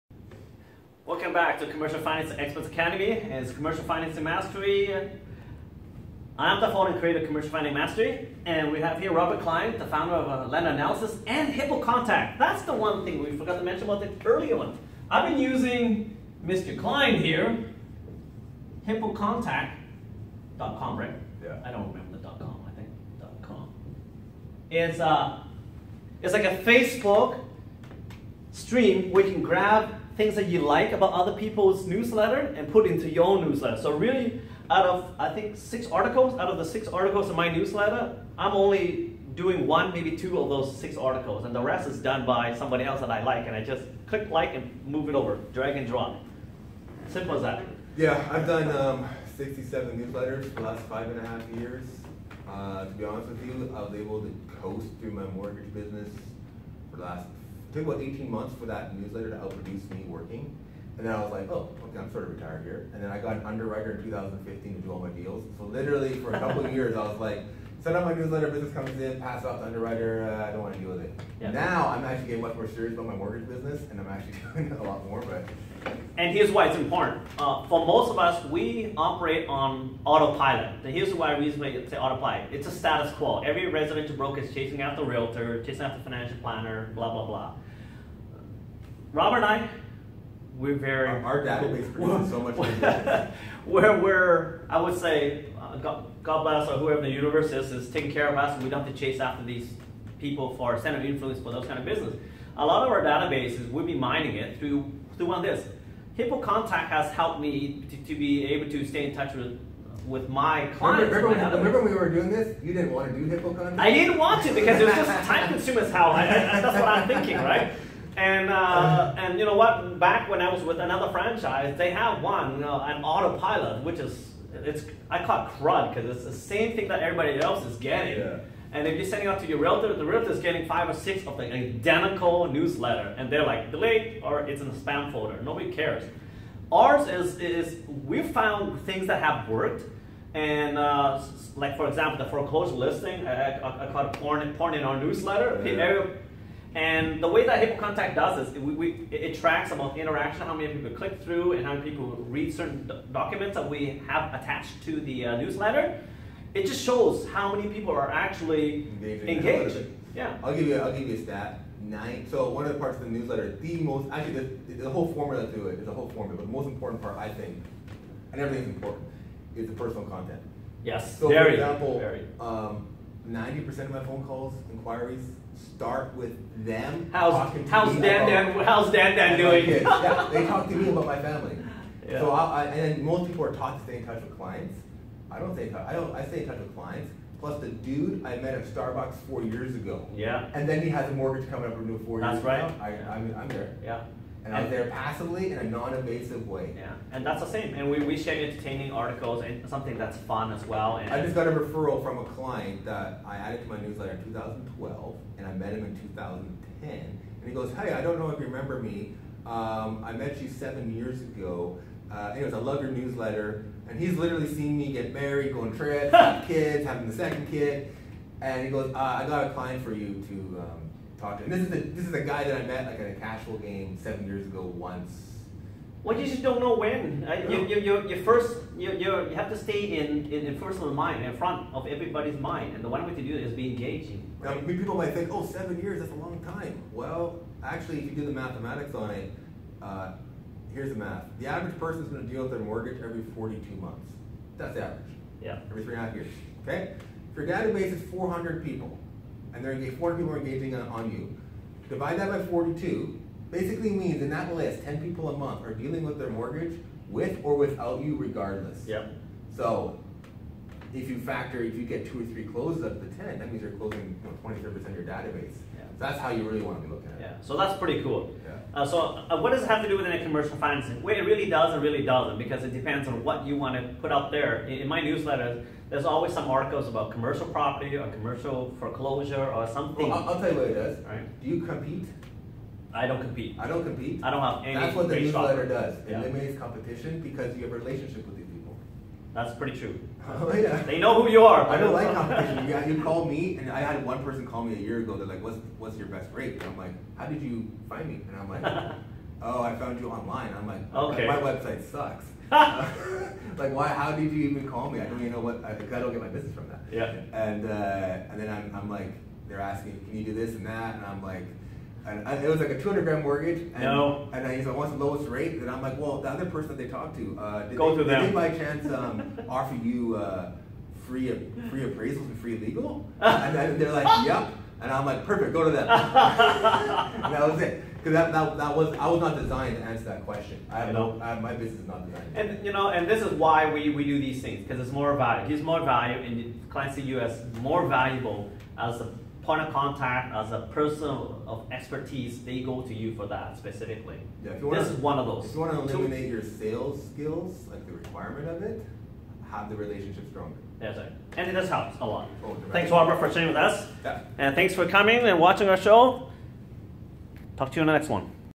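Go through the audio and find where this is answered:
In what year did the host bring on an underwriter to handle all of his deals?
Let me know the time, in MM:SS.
01:04.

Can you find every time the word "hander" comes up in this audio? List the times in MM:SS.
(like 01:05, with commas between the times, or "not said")
not said.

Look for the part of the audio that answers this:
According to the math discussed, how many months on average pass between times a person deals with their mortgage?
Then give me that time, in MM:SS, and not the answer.
04:03.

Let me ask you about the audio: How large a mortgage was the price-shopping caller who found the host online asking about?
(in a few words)
200 grand.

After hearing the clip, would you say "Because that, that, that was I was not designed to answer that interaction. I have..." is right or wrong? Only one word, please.
wrong.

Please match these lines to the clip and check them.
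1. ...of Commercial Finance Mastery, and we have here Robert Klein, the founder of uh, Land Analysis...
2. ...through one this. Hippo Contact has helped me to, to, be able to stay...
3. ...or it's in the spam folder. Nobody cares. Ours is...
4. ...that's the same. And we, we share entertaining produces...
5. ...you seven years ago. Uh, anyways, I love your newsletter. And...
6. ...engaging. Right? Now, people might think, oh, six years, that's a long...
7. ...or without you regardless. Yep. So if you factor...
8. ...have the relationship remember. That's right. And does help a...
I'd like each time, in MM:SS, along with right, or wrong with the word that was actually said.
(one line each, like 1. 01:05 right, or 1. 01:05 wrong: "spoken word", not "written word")
1. 00:07 right
2. 01:45 right
3. 02:14 right
4. 03:17 wrong: "articles", not "produces"
5. 03:30 right
6. 03:53 wrong: "seven", not "six"
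7. 04:17 right
8. 05:49 wrong: "stronger", not "remember".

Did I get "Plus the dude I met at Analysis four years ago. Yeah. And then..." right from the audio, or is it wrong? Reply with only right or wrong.
wrong.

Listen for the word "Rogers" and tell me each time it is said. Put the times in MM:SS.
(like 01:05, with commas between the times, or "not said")
not said.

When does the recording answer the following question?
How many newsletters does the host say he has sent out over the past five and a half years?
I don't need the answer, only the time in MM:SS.
00:49.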